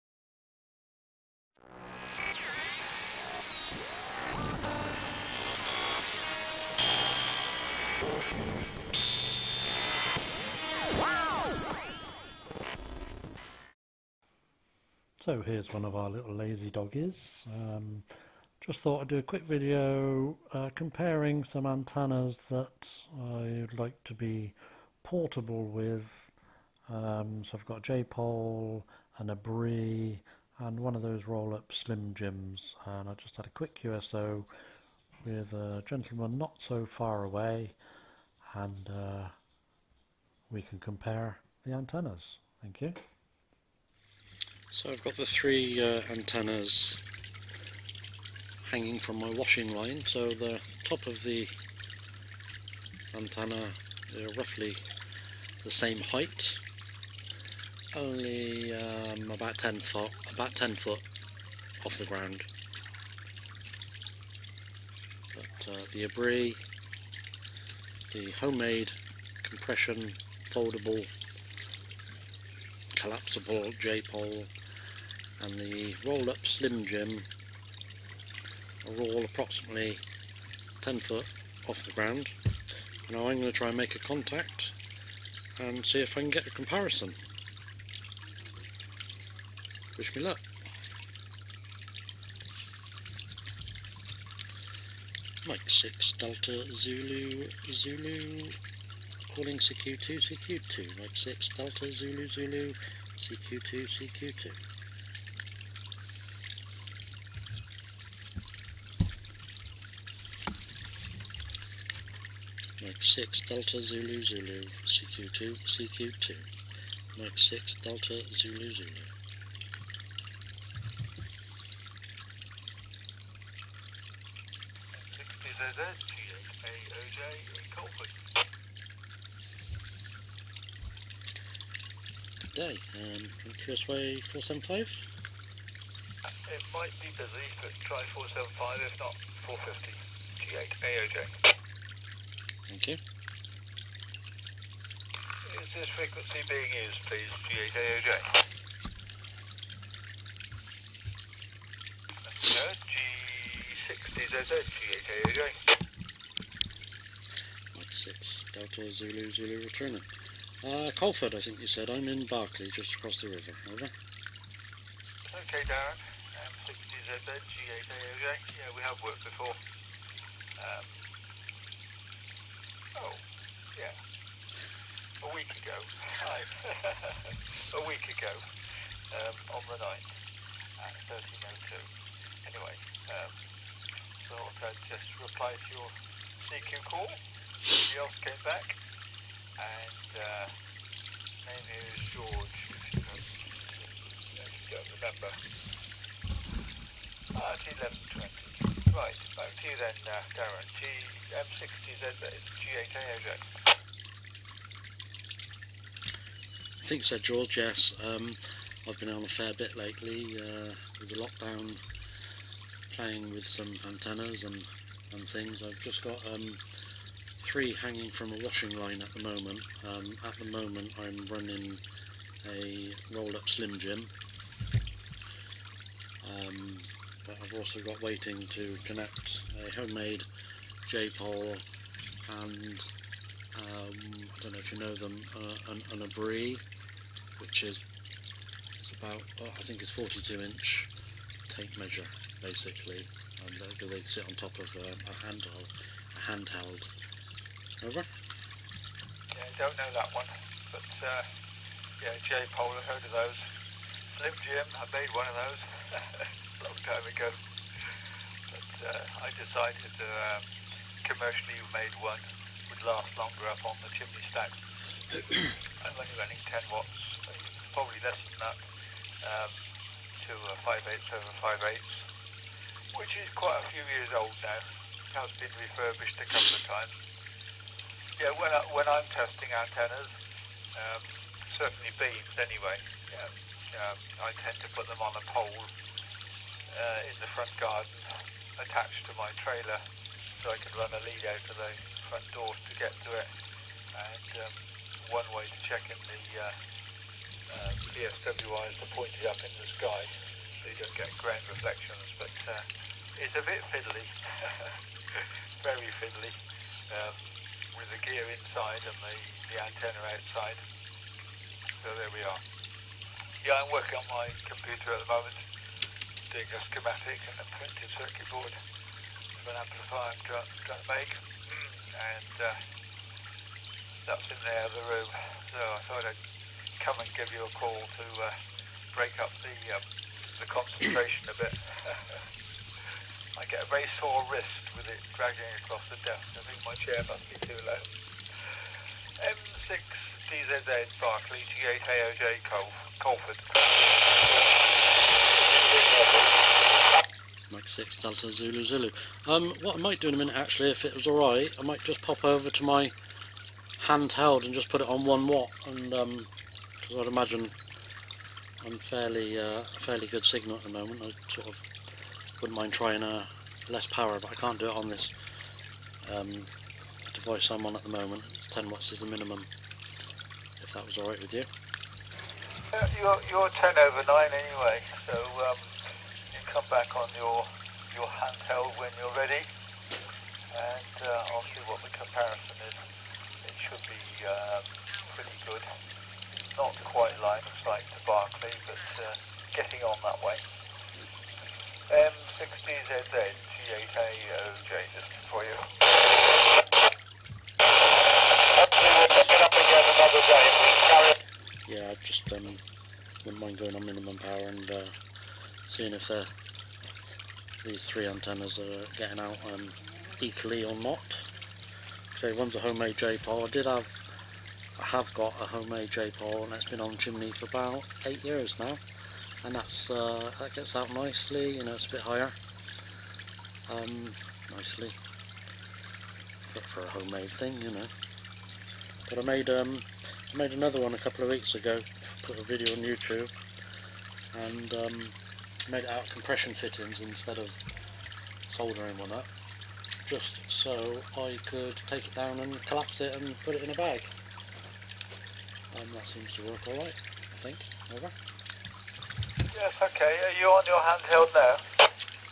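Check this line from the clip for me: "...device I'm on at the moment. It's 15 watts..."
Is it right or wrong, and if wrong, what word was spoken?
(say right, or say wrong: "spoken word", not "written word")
wrong: "10", not "15".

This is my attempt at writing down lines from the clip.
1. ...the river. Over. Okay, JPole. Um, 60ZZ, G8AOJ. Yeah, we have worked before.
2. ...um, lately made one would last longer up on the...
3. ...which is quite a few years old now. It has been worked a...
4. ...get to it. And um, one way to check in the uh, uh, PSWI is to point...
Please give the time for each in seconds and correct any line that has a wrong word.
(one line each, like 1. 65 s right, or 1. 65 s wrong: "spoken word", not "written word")
1. 163 s wrong: "Darren", not "JPole"
2. 260 s wrong: "commercially", not "lately"
3. 272 s wrong: "refurbished", not "worked"
4. 292 s right.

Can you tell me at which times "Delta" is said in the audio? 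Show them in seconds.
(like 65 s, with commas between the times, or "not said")
96 s, 101 s, 113 s, 117 s, 158 s, 347 s.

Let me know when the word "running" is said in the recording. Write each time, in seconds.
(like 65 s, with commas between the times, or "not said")
221 s, 266 s.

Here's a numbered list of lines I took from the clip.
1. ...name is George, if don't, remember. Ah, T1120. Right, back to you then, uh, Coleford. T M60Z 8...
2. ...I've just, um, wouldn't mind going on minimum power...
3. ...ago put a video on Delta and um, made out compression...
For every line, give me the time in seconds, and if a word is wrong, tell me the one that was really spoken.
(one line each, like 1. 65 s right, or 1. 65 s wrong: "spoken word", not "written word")
1. 191 s wrong: "Darren", not "Coleford"
2. 401 s right
3. 431 s wrong: "YouTube", not "Delta".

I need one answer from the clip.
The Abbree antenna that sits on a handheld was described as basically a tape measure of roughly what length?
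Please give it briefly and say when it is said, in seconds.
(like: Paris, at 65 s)
42 inch, at 239 s.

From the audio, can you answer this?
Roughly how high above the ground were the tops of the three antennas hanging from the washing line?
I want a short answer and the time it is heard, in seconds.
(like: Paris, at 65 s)
10 foot, at 60 s.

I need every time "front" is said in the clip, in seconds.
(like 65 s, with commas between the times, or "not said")
287 s, 292 s.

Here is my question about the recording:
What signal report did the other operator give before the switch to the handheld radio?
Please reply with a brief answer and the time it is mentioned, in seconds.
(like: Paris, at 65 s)
10 over 9, at 373 s.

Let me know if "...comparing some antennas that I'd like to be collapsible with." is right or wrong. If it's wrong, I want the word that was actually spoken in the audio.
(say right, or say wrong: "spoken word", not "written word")
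wrong: "portable", not "collapsible".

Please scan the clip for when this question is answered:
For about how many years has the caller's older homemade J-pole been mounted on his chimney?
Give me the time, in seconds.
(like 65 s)
417 s.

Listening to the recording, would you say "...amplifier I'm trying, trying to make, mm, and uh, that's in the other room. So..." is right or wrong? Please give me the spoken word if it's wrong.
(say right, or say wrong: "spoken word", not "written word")
right.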